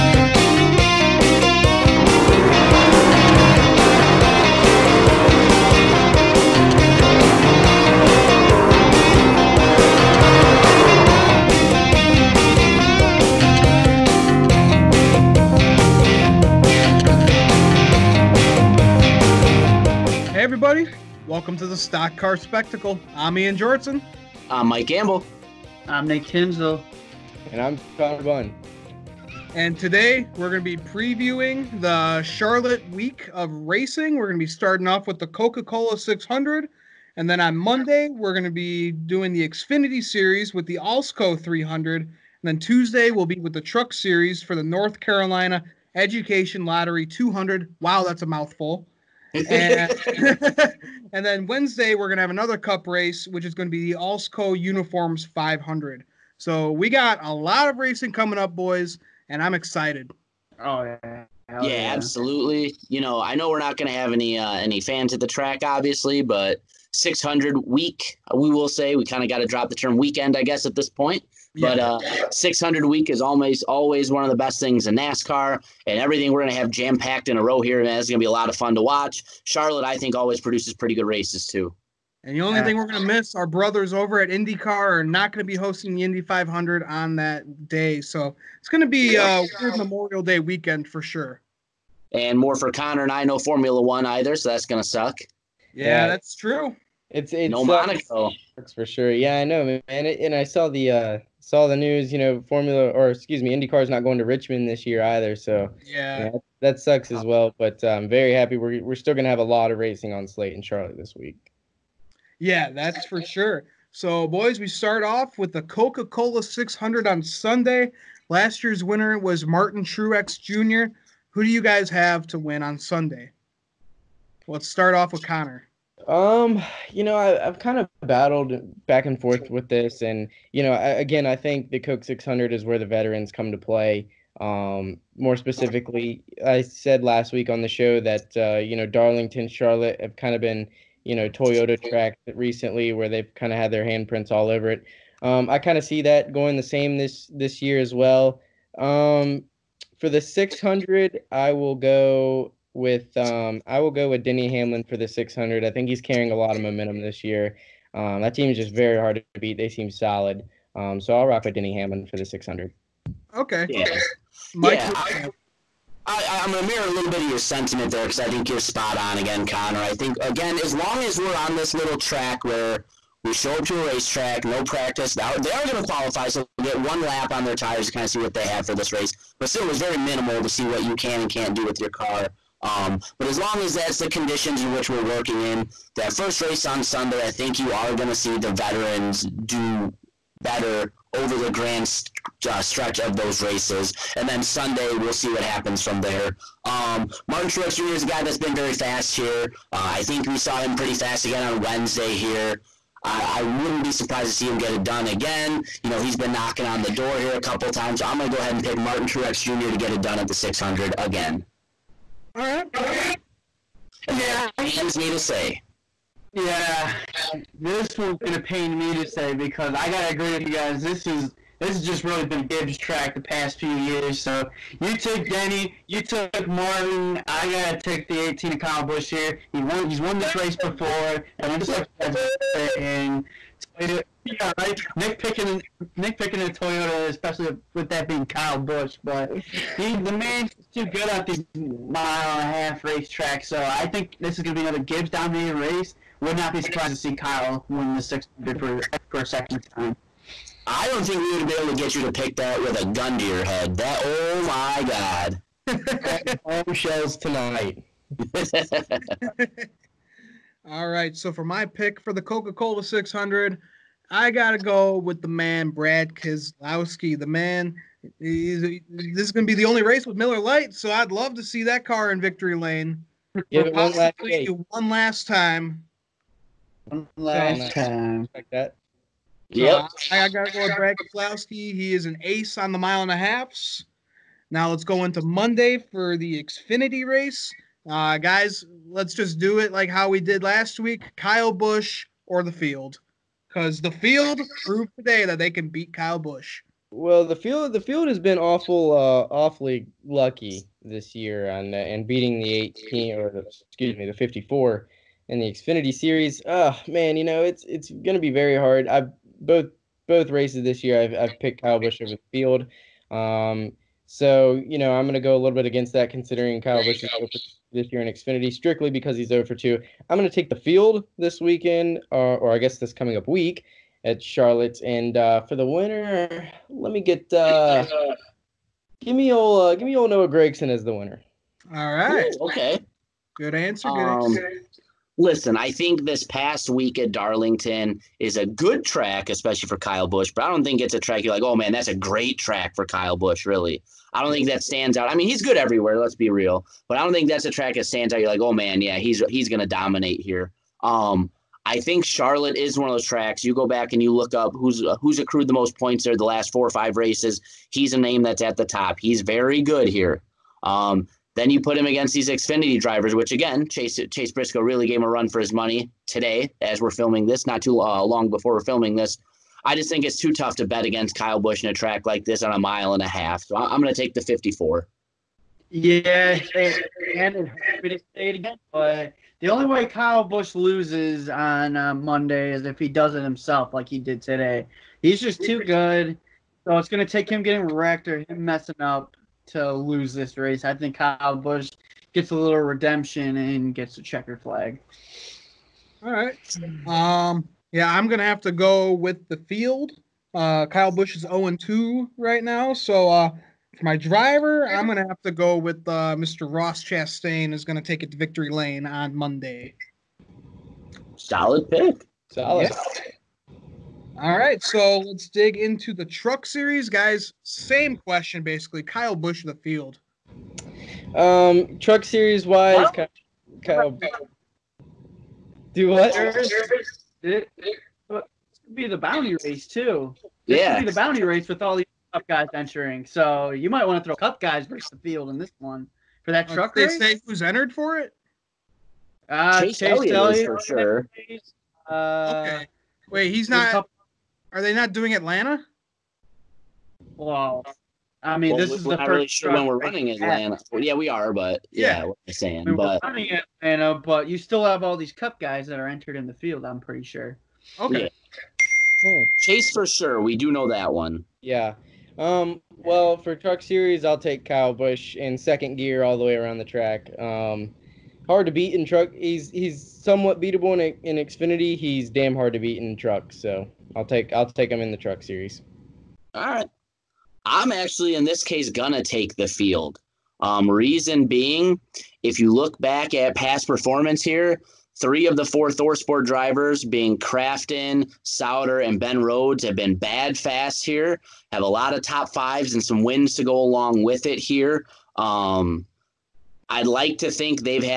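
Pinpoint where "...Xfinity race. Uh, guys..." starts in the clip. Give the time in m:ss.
4:46.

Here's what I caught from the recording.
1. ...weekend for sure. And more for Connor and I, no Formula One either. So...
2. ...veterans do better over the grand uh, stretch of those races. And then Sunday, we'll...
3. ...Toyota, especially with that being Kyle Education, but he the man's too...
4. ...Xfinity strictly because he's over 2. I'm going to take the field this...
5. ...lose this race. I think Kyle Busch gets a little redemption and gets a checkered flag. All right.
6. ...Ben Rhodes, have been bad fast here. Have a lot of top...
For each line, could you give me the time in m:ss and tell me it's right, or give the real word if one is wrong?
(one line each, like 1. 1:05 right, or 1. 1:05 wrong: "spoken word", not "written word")
1. 1:30 right
2. 3:08 right
3. 3:56 wrong: "Busch", not "Education"
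4. 5:18 right
5. 6:29 right
6. 8:08 right.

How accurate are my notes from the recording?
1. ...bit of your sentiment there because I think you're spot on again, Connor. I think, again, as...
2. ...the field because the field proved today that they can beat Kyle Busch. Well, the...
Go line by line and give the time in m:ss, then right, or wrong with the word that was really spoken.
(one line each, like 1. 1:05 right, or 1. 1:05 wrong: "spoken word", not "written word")
1. 2:47 right
2. 4:52 right.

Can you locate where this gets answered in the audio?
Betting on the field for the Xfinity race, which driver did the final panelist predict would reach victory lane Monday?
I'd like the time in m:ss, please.
6:46.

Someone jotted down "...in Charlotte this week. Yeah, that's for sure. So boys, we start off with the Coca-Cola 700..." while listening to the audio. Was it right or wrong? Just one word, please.
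wrong.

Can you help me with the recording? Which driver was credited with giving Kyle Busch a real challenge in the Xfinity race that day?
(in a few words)
Chase Briscoe.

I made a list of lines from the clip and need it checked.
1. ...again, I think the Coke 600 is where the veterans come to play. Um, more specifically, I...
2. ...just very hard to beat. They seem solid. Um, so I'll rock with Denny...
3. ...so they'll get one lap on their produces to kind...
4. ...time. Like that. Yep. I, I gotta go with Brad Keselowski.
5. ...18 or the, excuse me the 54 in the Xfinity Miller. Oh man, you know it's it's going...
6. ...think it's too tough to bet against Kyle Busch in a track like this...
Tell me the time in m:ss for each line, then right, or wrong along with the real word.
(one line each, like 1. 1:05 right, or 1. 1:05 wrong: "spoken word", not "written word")
1. 2:10 right
2. 2:38 right
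3. 2:56 wrong: "tires", not "produces"
4. 4:37 right
5. 5:02 wrong: "Series", not "Miller"
6. 6:09 right.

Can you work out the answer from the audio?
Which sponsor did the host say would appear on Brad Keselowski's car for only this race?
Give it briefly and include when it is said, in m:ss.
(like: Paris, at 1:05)
Miller Lite, at 4:30.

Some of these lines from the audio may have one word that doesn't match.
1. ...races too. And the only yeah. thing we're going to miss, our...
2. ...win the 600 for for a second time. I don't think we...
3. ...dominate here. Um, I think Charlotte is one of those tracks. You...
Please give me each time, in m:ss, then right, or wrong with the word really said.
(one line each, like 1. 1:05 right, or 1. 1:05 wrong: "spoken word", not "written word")
1. 1:21 right
2. 4:07 right
3. 5:49 right.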